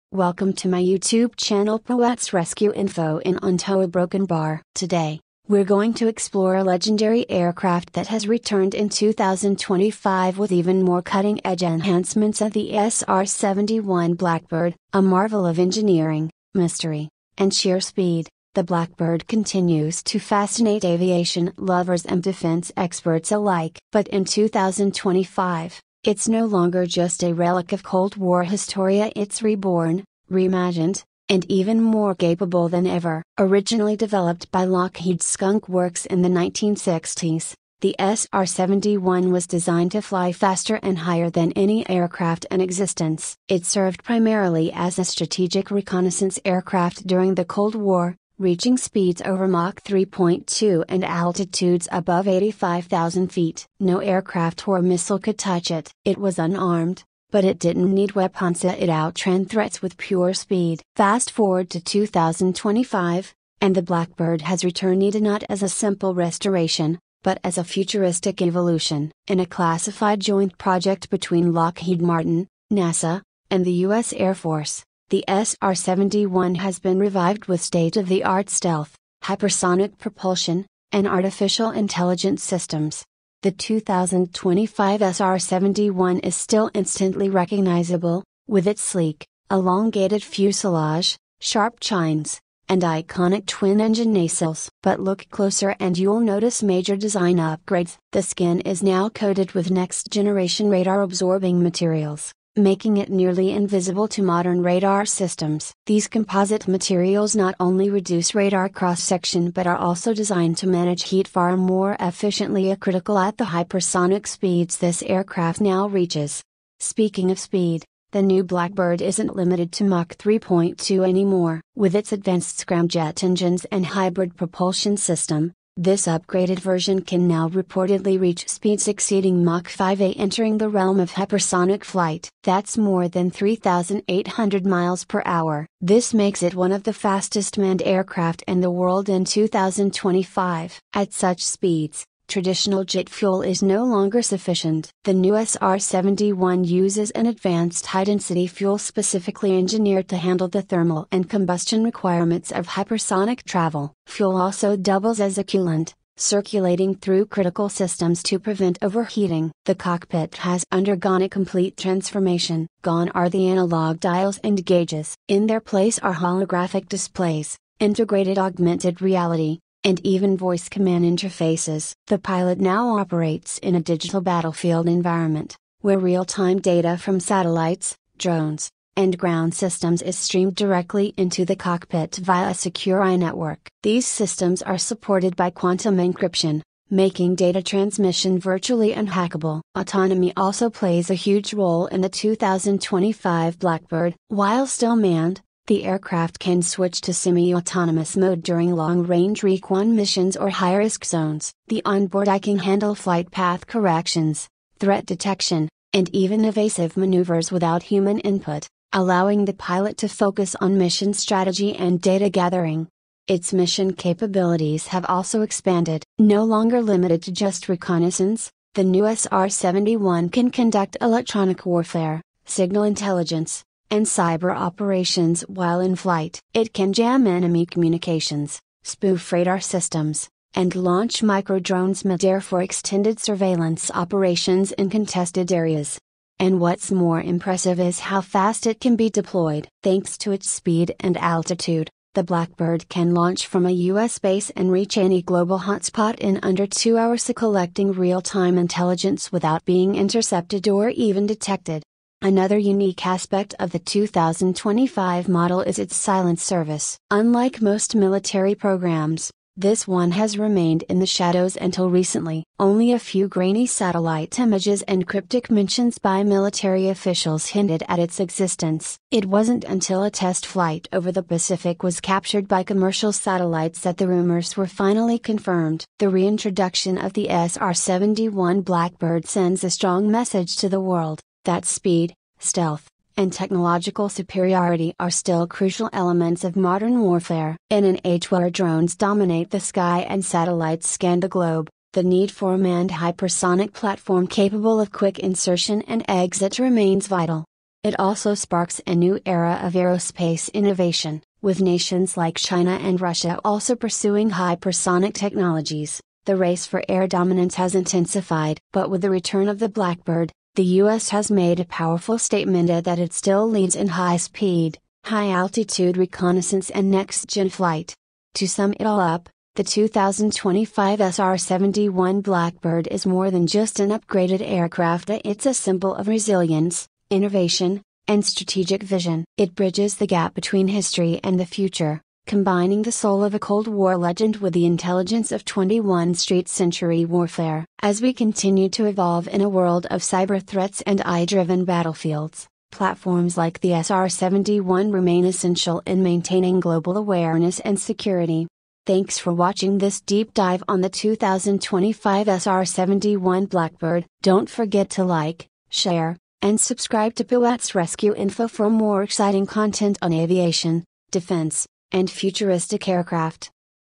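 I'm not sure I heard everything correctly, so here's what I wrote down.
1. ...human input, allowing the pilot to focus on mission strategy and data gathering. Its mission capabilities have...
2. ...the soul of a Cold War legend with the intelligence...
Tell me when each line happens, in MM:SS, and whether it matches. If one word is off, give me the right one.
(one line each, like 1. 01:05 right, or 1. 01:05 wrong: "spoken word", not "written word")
1. 03:27 right
2. 05:32 right.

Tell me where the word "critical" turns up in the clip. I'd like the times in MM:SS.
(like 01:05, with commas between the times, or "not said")
01:52, 02:37.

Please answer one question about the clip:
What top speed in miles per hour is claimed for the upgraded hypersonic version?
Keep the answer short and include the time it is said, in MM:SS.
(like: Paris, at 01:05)
3,800 miles per hour, at 02:13.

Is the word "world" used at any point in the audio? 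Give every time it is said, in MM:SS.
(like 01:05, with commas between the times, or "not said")
02:18, 04:40, 05:39.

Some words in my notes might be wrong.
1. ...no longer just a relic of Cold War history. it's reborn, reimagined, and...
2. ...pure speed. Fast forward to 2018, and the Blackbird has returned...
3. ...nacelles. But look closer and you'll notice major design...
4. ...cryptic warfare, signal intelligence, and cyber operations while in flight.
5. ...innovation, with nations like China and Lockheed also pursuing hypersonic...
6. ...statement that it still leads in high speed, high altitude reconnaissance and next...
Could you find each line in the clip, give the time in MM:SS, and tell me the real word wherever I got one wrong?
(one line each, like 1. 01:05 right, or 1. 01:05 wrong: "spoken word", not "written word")
1. 00:26 right
2. 00:59 wrong: "2025", not "2018"
3. 01:34 right
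4. 03:40 wrong: "electronic", not "cryptic"
5. 05:00 wrong: "Russia", not "Lockheed"
6. 05:12 right.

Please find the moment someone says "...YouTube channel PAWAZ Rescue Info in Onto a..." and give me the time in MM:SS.
00:00.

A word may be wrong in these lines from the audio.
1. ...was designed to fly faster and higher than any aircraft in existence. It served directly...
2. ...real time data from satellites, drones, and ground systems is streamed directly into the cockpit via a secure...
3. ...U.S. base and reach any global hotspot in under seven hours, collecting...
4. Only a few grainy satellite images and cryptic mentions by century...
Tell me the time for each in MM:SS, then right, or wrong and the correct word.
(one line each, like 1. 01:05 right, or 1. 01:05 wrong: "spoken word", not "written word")
1. 00:39 wrong: "primarily", not "directly"
2. 02:55 right
3. 04:03 wrong: "two", not "seven"
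4. 04:22 wrong: "military", not "century".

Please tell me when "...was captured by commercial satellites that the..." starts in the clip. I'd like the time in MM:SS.
04:31.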